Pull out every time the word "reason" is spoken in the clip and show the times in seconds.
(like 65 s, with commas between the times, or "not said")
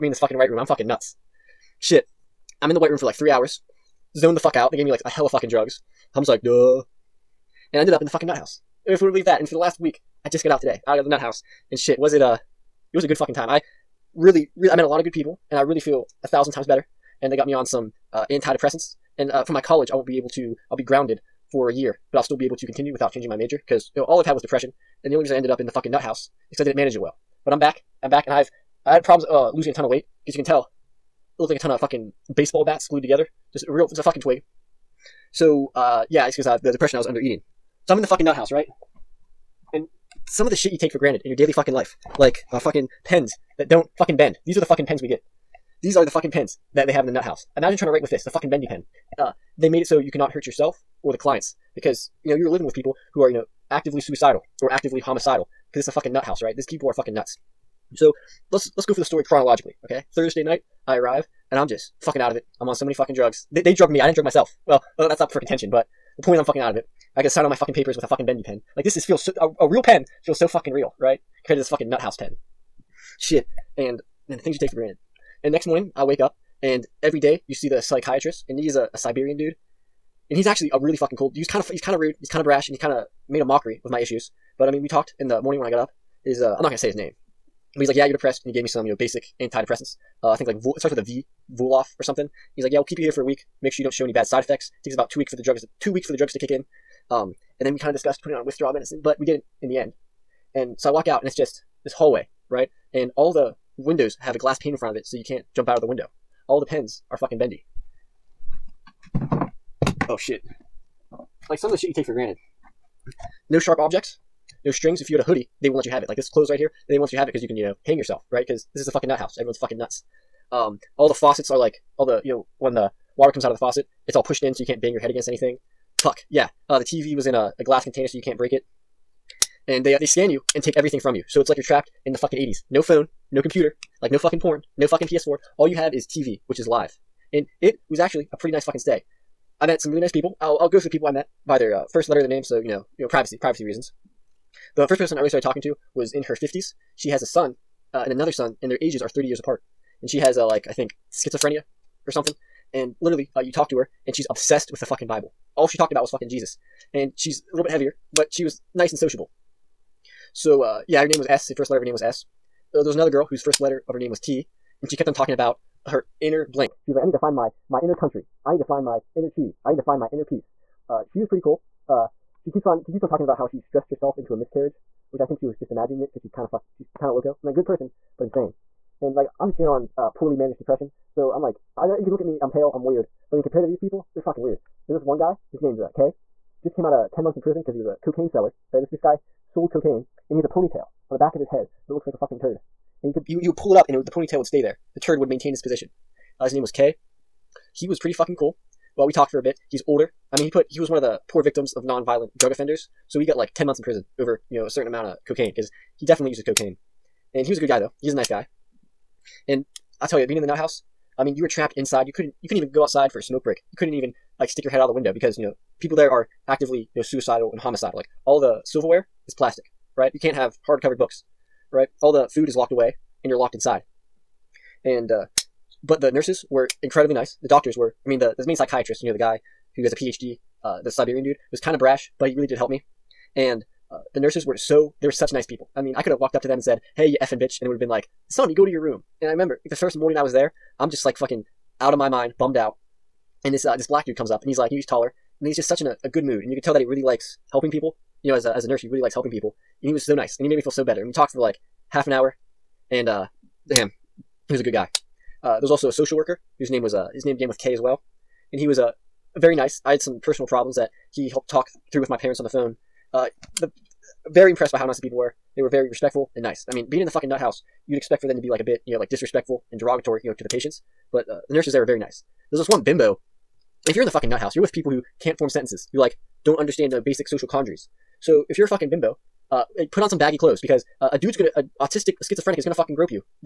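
25 s, 143 s.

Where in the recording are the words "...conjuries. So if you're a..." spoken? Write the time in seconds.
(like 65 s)
277 s.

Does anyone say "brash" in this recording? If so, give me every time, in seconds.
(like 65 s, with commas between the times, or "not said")
82 s, 231 s.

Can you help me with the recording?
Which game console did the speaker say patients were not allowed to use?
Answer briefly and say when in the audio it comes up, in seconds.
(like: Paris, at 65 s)
PS4, at 135 s.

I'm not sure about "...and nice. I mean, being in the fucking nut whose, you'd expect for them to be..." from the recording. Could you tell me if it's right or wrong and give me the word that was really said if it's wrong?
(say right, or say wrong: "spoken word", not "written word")
wrong: "house", not "whose".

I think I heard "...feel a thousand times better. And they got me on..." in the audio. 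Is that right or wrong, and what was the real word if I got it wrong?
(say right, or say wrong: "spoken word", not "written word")
right.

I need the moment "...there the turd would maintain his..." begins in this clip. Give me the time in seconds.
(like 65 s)
194 s.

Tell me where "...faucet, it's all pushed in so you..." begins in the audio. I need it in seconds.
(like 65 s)
123 s.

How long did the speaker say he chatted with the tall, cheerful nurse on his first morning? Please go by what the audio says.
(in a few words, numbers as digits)
half an hour.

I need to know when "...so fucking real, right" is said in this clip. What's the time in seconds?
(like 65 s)
70 s.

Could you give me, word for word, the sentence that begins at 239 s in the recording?
And I remember like, the first morning I was there, I'm just like fucking out of my mind, bummed out.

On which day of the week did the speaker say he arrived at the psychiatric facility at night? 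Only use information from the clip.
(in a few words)
Thursday.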